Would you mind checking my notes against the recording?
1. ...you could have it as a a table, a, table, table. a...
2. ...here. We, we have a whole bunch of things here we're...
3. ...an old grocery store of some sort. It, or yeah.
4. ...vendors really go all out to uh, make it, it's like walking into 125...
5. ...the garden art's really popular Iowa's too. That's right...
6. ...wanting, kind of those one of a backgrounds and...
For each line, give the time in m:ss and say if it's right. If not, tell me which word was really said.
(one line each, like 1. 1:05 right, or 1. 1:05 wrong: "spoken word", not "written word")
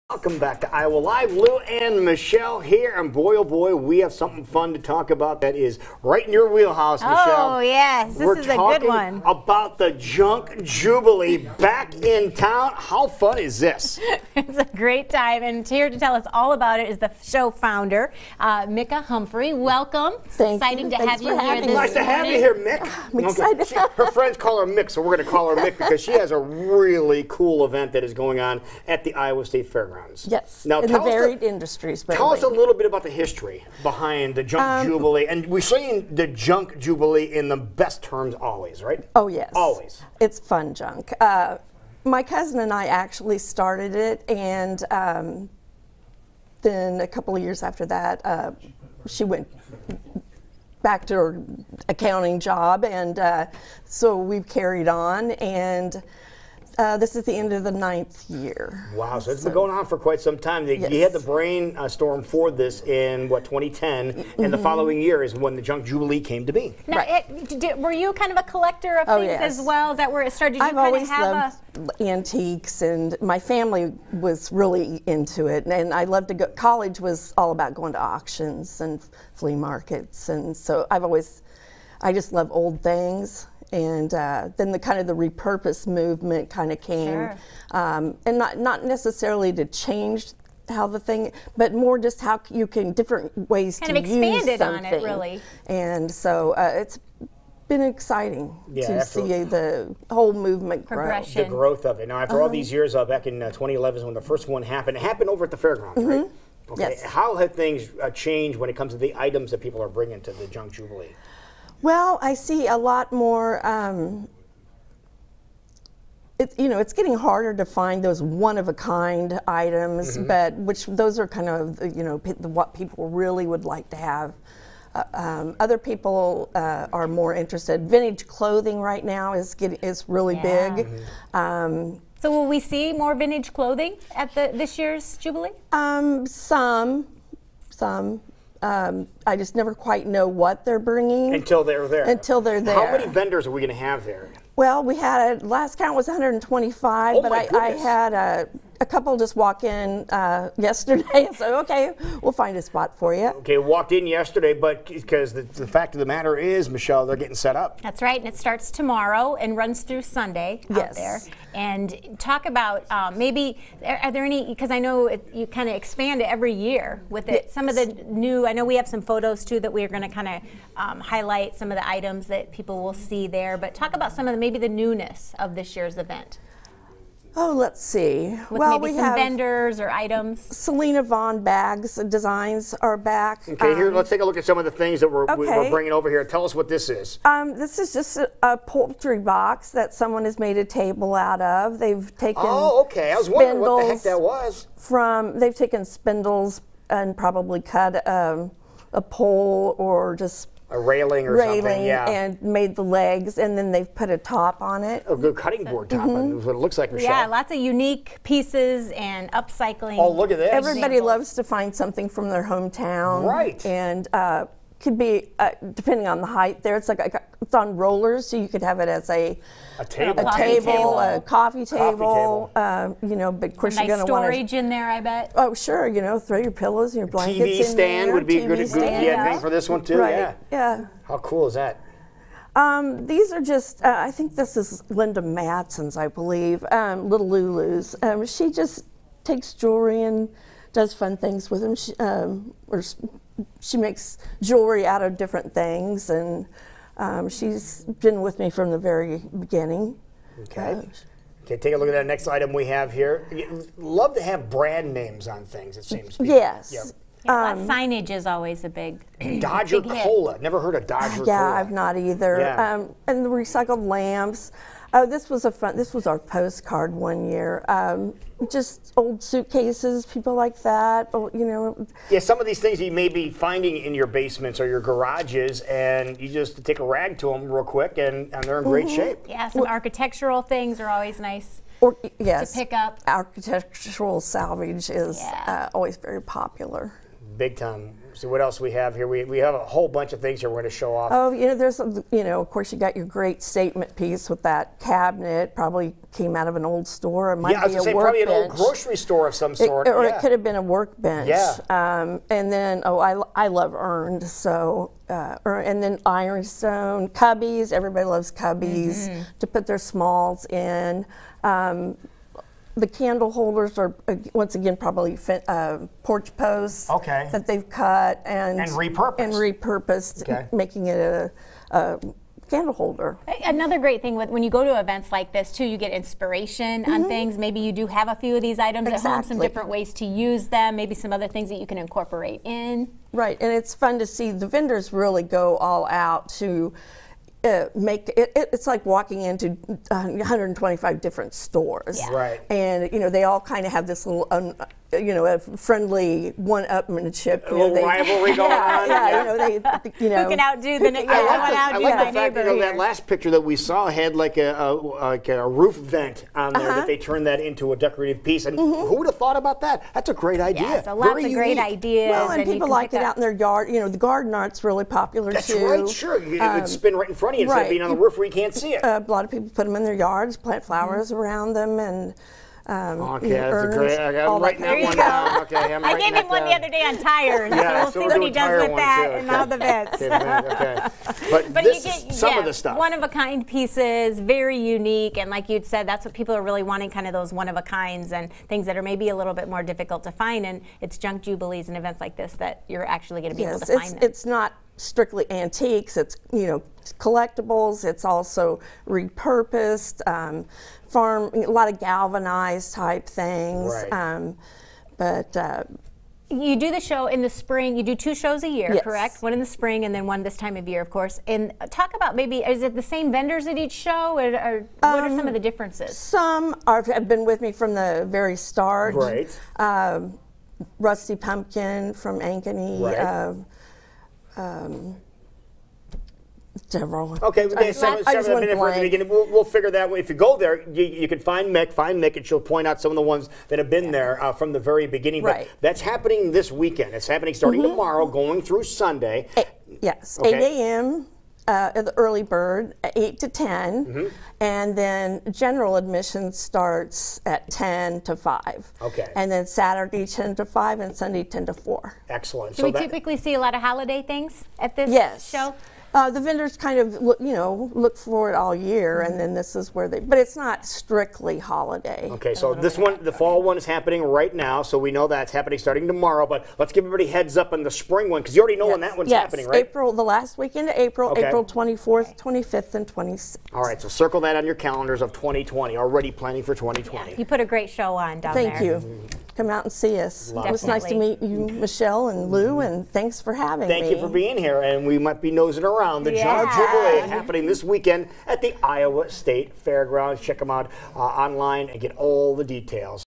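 1. 3:38 right
2. 4:48 right
3. 4:58 right
4. 5:34 right
5. 6:03 wrong: "That", not "Iowa"
6. 6:26 wrong: "kinds", not "backgrounds".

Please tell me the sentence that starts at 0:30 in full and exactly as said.
Yes, now, in the varied the, industries.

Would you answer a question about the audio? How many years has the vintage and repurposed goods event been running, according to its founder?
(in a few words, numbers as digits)
9.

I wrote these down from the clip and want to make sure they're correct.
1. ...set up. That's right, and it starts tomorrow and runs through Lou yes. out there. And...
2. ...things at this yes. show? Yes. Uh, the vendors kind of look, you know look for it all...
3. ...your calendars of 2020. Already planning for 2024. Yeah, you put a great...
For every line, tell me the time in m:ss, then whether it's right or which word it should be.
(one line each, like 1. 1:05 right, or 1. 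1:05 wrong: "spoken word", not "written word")
1. 2:37 wrong: "Sunday", not "Lou"
2. 7:34 right
3. 7:54 wrong: "2020", not "2024".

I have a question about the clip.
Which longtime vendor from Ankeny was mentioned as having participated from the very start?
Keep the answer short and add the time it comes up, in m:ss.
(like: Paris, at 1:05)
Rusty Pumpkin, at 7:00.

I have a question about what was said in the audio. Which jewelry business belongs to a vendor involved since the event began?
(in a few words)
Little Lulu's.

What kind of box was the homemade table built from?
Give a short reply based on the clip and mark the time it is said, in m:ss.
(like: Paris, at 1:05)
Poultry box, at 3:08.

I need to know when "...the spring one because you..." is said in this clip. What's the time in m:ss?
7:47.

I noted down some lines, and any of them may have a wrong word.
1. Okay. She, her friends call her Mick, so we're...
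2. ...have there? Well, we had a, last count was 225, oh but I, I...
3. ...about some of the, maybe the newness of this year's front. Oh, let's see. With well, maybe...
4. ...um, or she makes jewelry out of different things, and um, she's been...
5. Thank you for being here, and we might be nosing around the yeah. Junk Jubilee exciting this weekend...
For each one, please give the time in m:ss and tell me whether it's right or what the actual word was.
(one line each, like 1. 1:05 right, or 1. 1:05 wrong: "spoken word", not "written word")
1. 0:23 right
2. 2:23 wrong: "125", not "225"
3. 2:53 wrong: "event", not "front"
4. 4:02 right
5. 8:03 wrong: "happening", not "exciting".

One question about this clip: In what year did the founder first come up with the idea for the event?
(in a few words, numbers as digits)
2010.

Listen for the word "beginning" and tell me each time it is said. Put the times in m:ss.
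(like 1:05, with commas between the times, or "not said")
4:09, 7:08, 7:14.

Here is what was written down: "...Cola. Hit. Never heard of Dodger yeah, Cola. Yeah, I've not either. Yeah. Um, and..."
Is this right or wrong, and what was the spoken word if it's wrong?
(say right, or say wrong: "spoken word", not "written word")
right.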